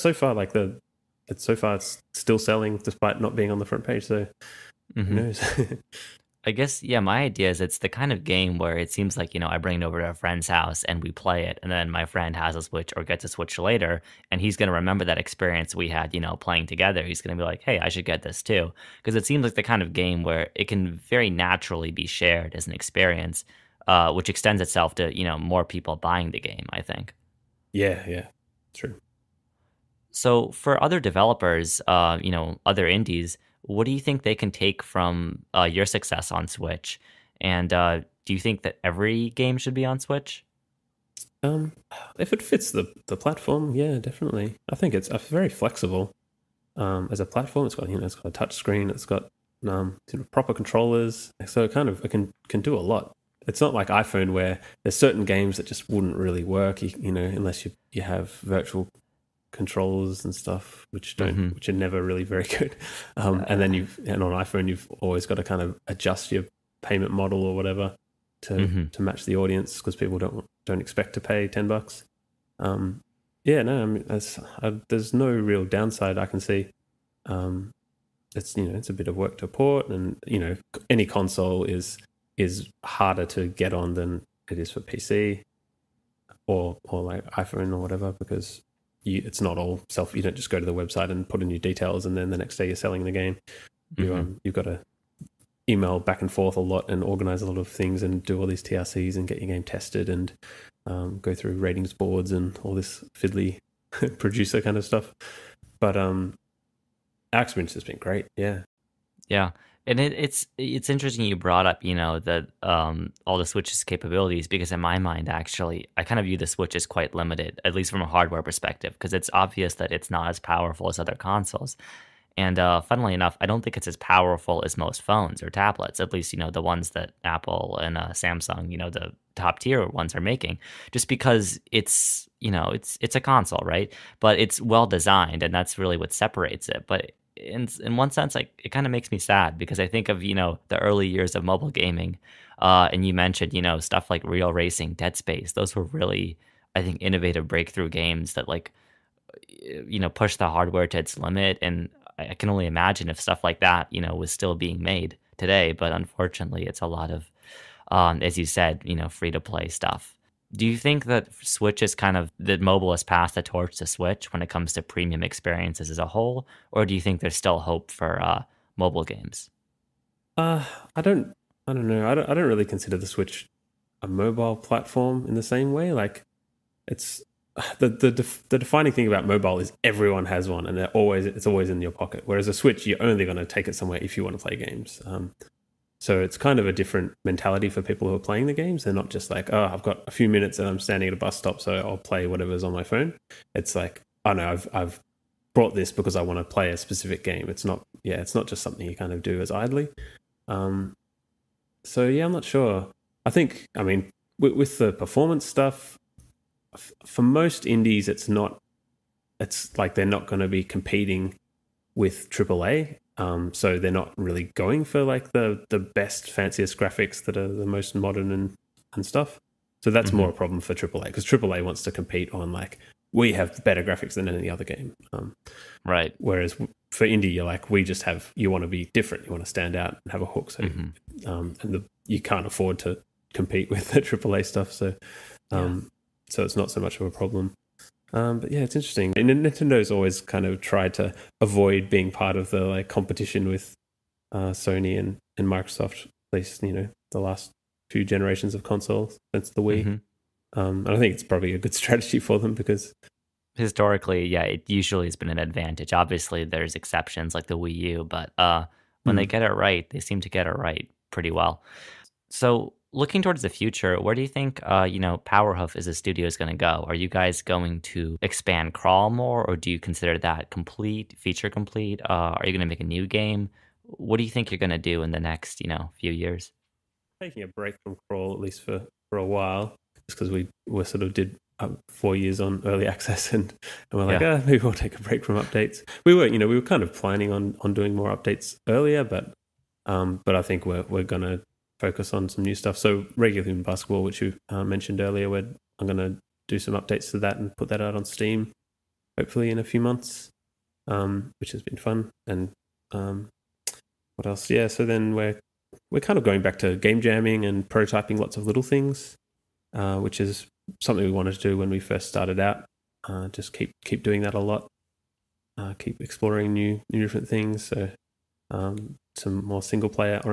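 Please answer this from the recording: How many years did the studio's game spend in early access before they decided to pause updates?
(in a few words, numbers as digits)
4.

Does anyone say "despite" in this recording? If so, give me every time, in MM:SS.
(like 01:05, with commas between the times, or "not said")
00:02.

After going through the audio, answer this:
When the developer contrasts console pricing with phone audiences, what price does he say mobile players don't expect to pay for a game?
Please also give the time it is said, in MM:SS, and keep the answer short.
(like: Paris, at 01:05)
$10, at 01:11.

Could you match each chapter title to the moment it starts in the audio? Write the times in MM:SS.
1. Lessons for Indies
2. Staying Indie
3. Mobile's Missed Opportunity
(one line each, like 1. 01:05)
1. 00:29
2. 04:22
3. 01:49.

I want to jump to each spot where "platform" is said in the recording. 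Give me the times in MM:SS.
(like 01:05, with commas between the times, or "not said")
00:43, 00:47, 02:54.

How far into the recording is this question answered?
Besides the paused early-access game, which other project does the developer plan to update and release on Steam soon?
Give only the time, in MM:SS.
04:53.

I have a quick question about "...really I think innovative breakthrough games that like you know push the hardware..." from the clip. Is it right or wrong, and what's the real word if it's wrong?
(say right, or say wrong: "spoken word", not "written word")
right.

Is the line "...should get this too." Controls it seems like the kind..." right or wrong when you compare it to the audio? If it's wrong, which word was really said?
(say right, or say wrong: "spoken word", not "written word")
wrong: "Because", not "Controls".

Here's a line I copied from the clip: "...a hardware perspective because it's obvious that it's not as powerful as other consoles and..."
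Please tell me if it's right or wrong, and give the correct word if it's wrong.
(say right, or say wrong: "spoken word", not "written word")
right.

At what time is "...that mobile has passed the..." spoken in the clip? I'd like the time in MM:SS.
02:42.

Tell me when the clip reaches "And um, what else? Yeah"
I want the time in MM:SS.
05:02.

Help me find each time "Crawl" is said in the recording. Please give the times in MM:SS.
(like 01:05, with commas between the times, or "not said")
04:28, 04:38.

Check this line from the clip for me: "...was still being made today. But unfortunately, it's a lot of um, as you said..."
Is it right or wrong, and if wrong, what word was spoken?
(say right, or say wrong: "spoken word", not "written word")
right.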